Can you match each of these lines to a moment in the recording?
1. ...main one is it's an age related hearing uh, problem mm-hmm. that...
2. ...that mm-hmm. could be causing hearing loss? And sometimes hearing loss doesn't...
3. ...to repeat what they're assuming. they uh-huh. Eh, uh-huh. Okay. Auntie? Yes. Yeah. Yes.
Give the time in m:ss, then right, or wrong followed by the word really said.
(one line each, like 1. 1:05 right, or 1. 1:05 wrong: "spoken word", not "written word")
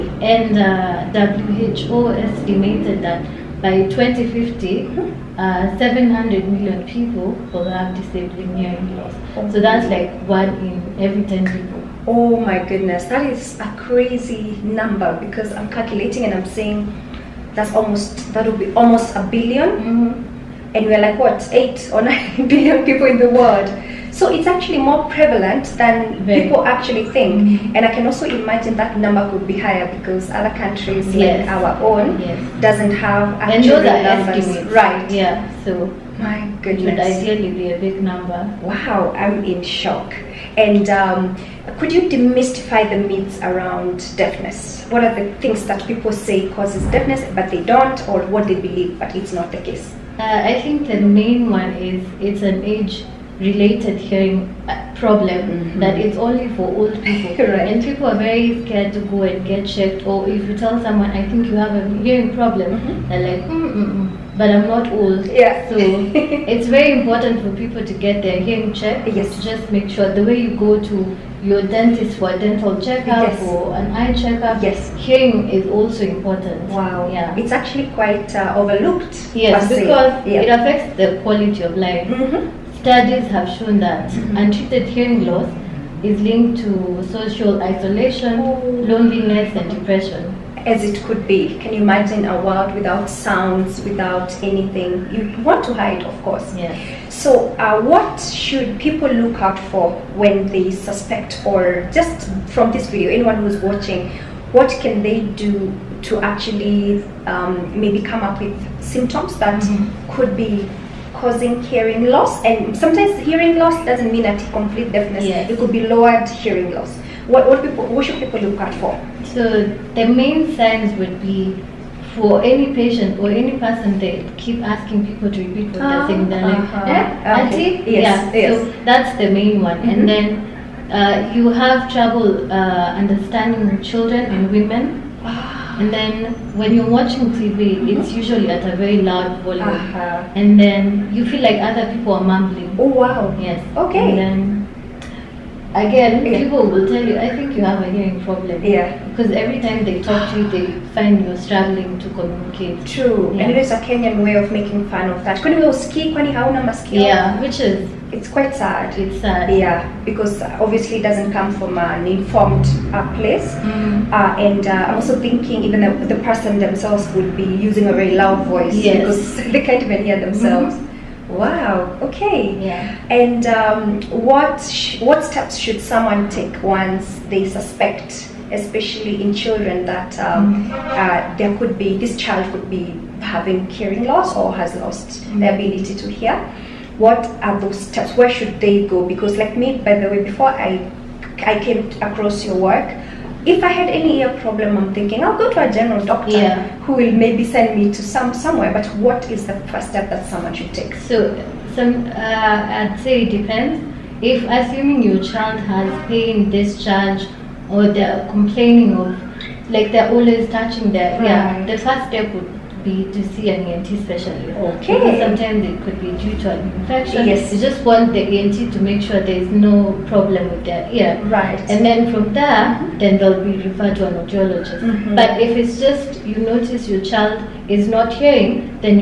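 1. 0:51 right
2. 1:49 right
3. 2:05 wrong: "saying", not "assuming".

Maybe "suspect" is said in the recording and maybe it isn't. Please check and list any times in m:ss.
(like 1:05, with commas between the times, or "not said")
1:40, 2:57.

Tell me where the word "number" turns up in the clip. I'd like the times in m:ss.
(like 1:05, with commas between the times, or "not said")
0:14, 0:28, 0:34, 0:38.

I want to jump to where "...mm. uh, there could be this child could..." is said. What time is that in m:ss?
3:00.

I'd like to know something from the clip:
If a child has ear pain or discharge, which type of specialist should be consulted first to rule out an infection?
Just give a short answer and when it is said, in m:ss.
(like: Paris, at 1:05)
ENT specialist, at 3:33.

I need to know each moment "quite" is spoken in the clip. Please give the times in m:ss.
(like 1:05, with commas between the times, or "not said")
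1:17, 2:38.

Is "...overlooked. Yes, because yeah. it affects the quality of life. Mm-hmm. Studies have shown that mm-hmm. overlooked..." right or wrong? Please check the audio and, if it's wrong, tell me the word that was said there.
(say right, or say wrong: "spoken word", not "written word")
wrong: "untreated", not "overlooked".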